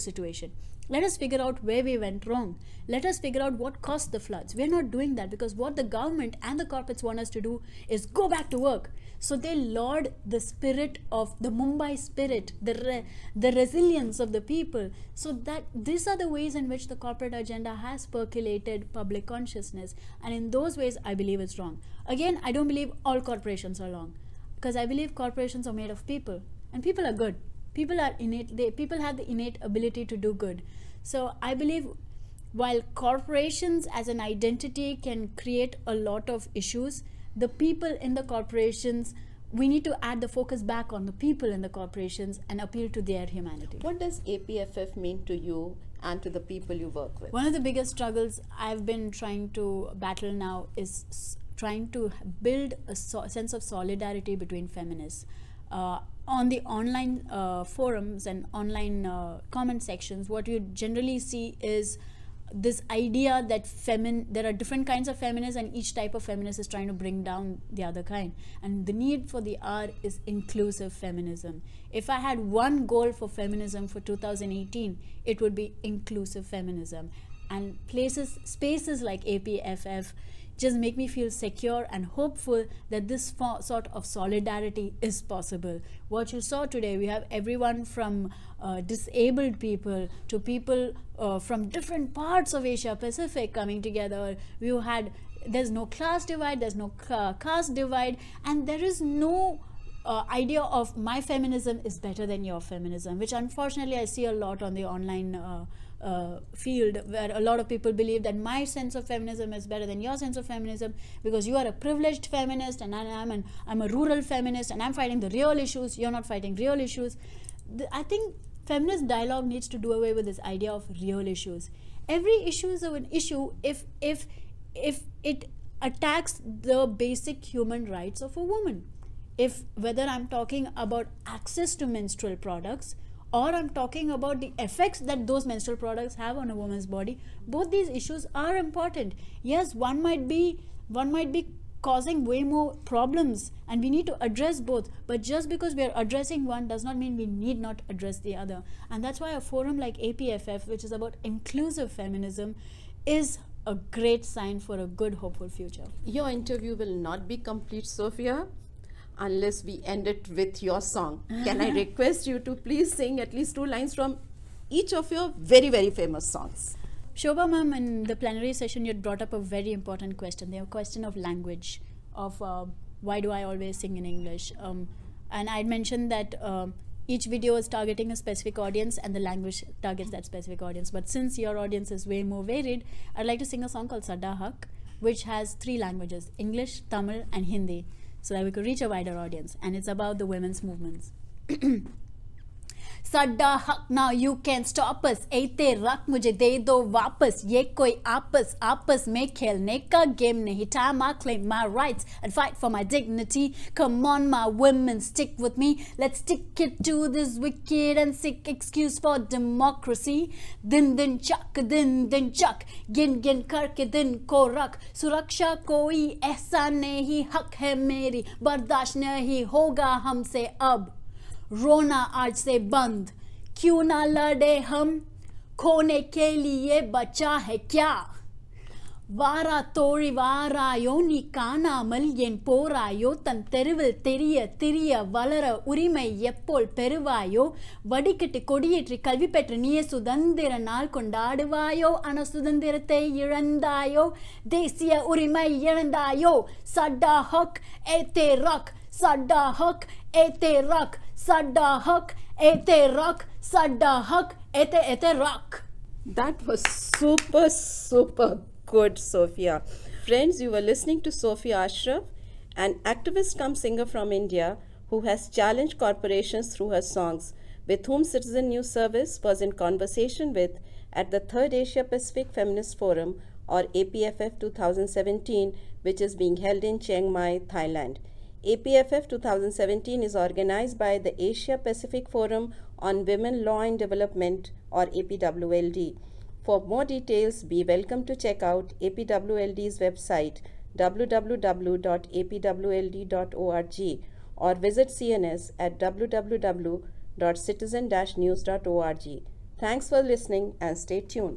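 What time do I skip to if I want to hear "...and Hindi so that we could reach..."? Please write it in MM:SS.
03:07.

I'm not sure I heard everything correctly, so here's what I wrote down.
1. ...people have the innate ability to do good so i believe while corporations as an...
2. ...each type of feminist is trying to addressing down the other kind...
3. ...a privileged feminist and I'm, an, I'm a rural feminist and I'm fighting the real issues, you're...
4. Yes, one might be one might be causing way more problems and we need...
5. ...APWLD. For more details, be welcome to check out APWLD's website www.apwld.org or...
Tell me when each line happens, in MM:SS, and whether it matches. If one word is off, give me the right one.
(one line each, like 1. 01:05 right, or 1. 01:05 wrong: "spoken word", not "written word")
1. 00:28 right
2. 01:05 wrong: "bring", not "addressing"
3. 01:51 right
4. 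02:19 right
5. 04:44 right.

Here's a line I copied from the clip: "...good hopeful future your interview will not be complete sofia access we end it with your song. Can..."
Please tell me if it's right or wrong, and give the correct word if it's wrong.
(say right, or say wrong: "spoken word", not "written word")
wrong: "unless", not "access".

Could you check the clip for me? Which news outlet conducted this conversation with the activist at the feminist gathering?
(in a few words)
Citizen News Service.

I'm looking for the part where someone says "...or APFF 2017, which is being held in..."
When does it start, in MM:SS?
04:33.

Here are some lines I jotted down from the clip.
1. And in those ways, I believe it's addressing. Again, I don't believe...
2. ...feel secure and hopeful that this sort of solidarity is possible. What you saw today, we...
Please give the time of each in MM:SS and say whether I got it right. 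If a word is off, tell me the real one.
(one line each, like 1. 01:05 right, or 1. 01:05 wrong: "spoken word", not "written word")
1. 00:20 wrong: "wrong", not "addressing"
2. 01:21 right.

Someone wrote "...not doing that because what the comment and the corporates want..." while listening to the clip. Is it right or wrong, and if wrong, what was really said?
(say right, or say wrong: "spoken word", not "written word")
wrong: "government", not "comment".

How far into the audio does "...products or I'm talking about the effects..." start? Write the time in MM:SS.
02:12.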